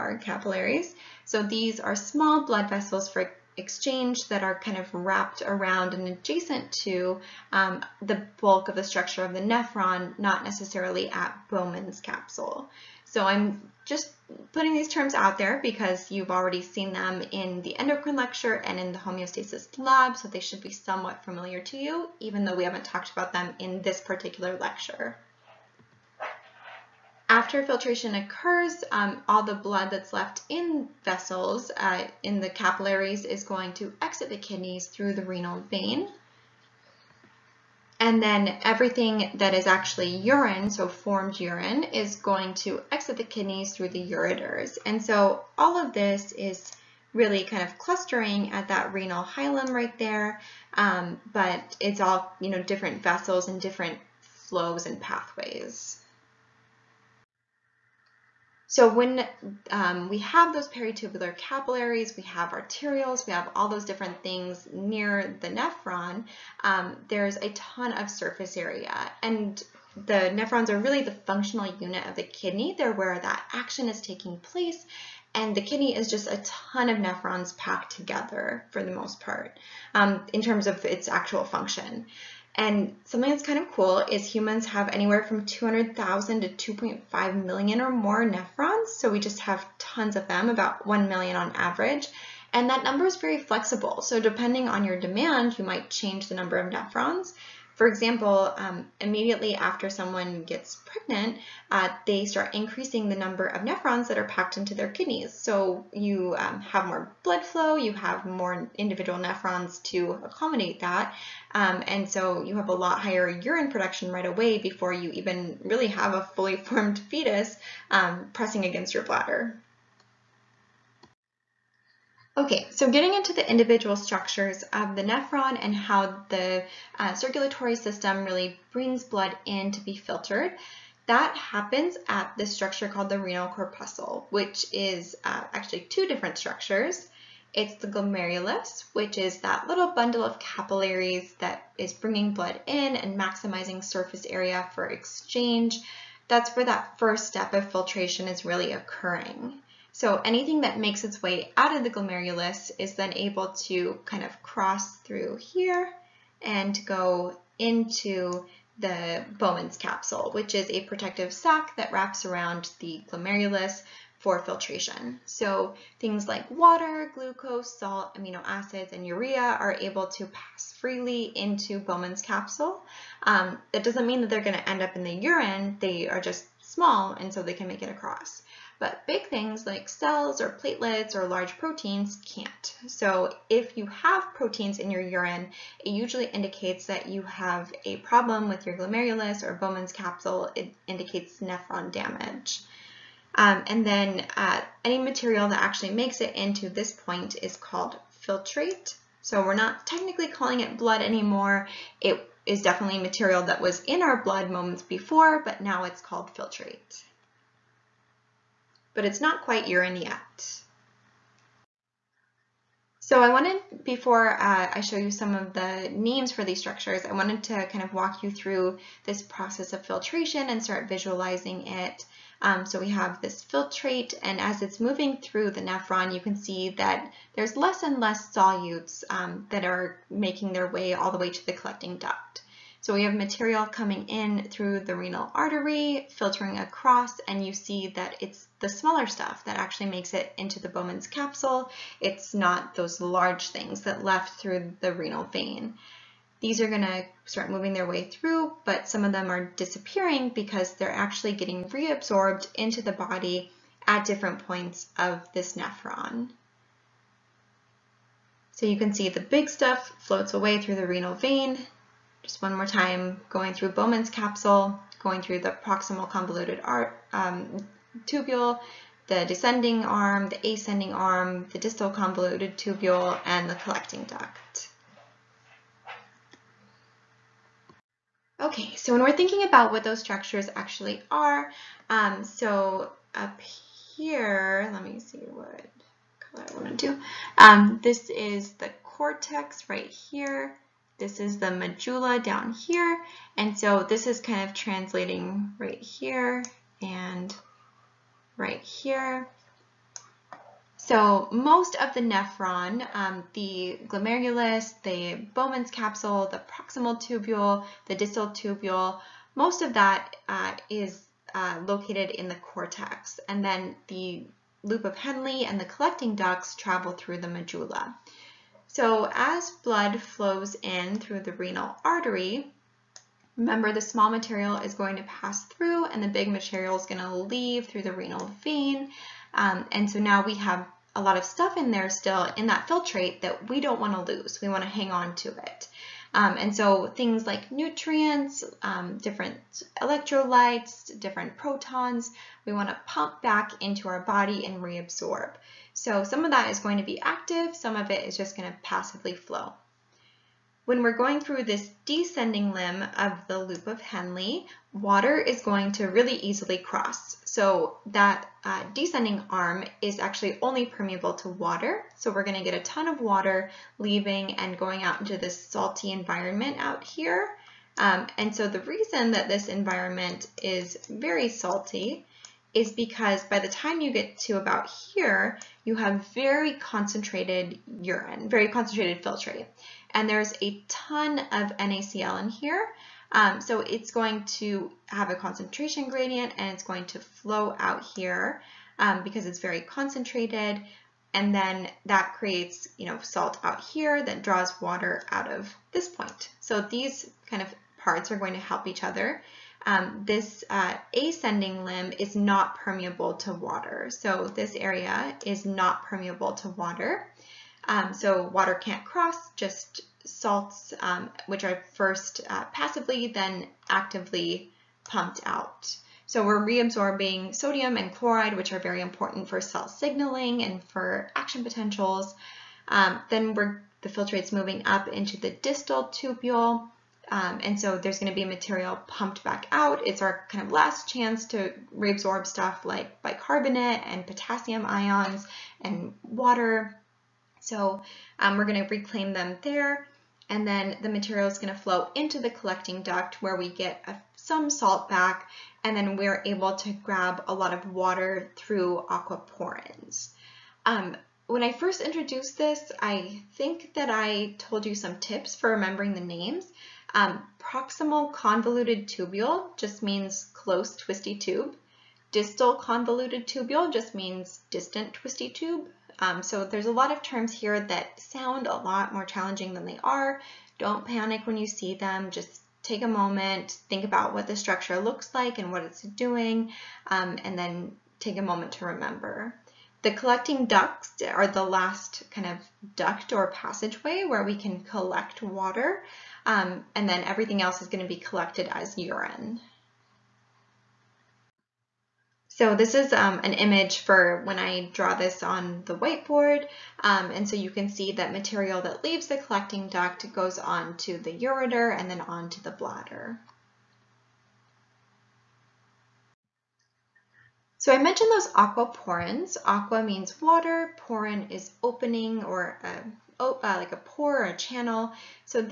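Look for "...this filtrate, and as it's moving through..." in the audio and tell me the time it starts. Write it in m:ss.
3:43.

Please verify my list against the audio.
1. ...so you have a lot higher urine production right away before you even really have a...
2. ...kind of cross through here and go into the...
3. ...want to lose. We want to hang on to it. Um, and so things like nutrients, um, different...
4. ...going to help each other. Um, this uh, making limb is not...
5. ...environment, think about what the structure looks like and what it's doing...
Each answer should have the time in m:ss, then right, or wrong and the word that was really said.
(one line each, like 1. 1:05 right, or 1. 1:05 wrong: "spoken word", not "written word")
1. 1:52 right
2. 2:34 right
3. 5:33 right
4. 6:38 wrong: "ascending", not "making"
5. 7:52 wrong: "moment", not "environment".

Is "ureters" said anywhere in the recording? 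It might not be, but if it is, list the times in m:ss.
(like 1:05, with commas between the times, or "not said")
0:44, 8:21.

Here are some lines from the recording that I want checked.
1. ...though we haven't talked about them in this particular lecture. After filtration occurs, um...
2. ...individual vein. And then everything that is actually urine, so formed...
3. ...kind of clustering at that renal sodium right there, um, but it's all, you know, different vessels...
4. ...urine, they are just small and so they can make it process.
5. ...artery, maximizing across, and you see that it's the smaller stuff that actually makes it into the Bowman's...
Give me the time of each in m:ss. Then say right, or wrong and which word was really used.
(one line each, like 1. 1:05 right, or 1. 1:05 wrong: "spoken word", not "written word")
1. 0:22 right
2. 0:35 wrong: "renal", not "individual"
3. 0:47 wrong: "hilum", not "sodium"
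4. 2:55 wrong: "across", not "process"
5. 3:55 wrong: "filtering", not "maximizing".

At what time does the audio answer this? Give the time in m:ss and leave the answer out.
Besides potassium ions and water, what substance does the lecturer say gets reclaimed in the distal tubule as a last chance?
7:13.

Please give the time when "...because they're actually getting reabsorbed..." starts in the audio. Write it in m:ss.
4:10.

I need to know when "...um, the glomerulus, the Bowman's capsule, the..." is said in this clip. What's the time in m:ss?
5:02.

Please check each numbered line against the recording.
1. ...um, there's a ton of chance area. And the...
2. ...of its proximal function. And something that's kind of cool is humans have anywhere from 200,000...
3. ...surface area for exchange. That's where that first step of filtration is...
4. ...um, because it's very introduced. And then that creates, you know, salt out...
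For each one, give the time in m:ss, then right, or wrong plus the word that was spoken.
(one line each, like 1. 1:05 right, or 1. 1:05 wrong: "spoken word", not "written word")
1. 1:06 wrong: "surface", not "chance"
2. 1:20 wrong: "actual", not "proximal"
3. 2:23 right
4. 6:28 wrong: "concentrated", not "introduced".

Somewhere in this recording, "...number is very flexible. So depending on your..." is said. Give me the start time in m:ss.
1:32.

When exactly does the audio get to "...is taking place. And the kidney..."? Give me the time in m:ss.
1:13.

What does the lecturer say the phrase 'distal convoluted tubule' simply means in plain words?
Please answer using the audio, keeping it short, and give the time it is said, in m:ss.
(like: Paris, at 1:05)
distant twisty tube, at 7:44.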